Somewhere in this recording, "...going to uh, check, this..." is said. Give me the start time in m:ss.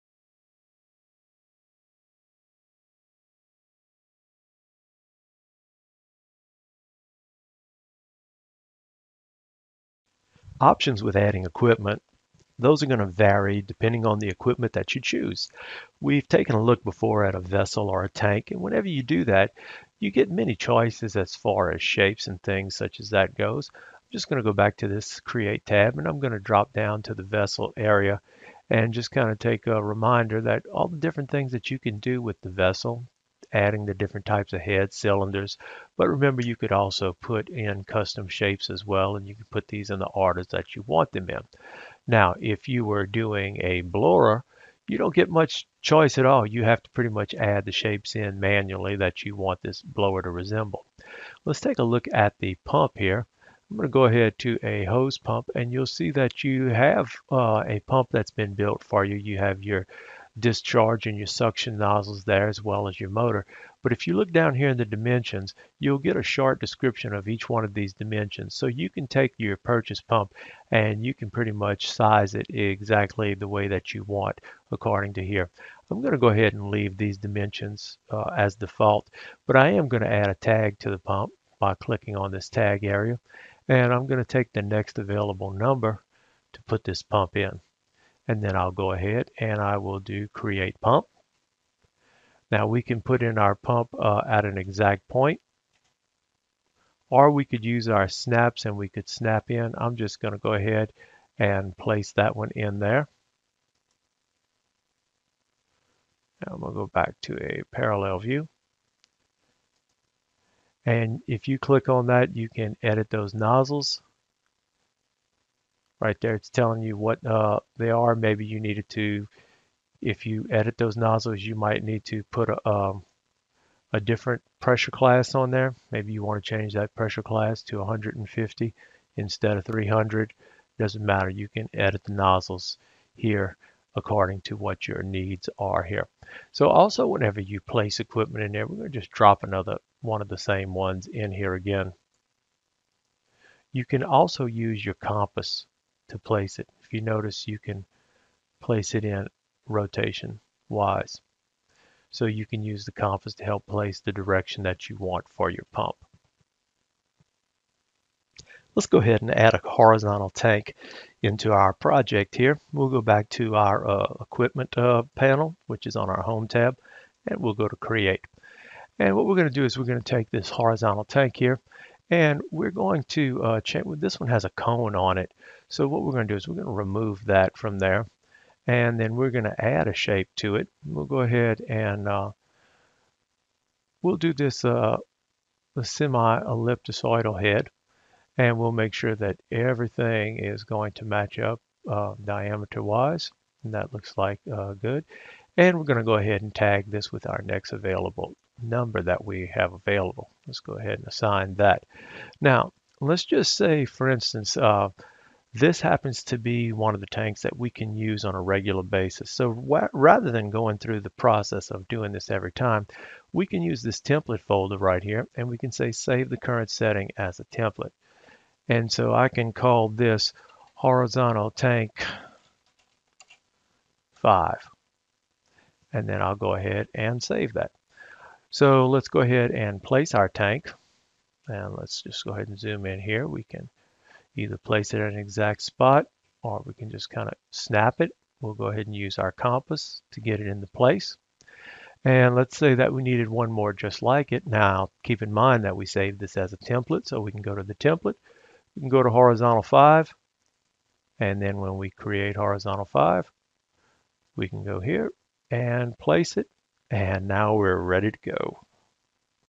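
2:52.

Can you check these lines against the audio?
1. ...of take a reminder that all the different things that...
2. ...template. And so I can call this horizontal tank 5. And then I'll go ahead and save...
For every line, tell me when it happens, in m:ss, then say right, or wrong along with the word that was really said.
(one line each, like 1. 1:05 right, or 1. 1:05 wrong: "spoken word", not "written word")
1. 0:29 right
2. 3:37 right.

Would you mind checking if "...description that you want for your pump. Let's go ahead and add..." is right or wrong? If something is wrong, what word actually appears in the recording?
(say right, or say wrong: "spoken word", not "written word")
wrong: "direction", not "description".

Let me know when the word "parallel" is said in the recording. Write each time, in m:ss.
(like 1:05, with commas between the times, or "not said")
1:47.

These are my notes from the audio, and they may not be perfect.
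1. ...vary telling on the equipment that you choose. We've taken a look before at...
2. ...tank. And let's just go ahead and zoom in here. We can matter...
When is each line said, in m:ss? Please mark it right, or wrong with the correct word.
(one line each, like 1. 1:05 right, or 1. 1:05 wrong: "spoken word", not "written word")
1. 0:13 wrong: "depending", not "telling"
2. 3:50 wrong: "either", not "matter".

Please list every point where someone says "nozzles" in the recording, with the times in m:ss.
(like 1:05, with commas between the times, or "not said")
1:01, 1:53, 2:00, 2:12.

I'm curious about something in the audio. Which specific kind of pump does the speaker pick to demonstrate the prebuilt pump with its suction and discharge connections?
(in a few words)
hose pump.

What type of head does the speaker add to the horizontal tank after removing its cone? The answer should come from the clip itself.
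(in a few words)
semi-ellipticoidal head.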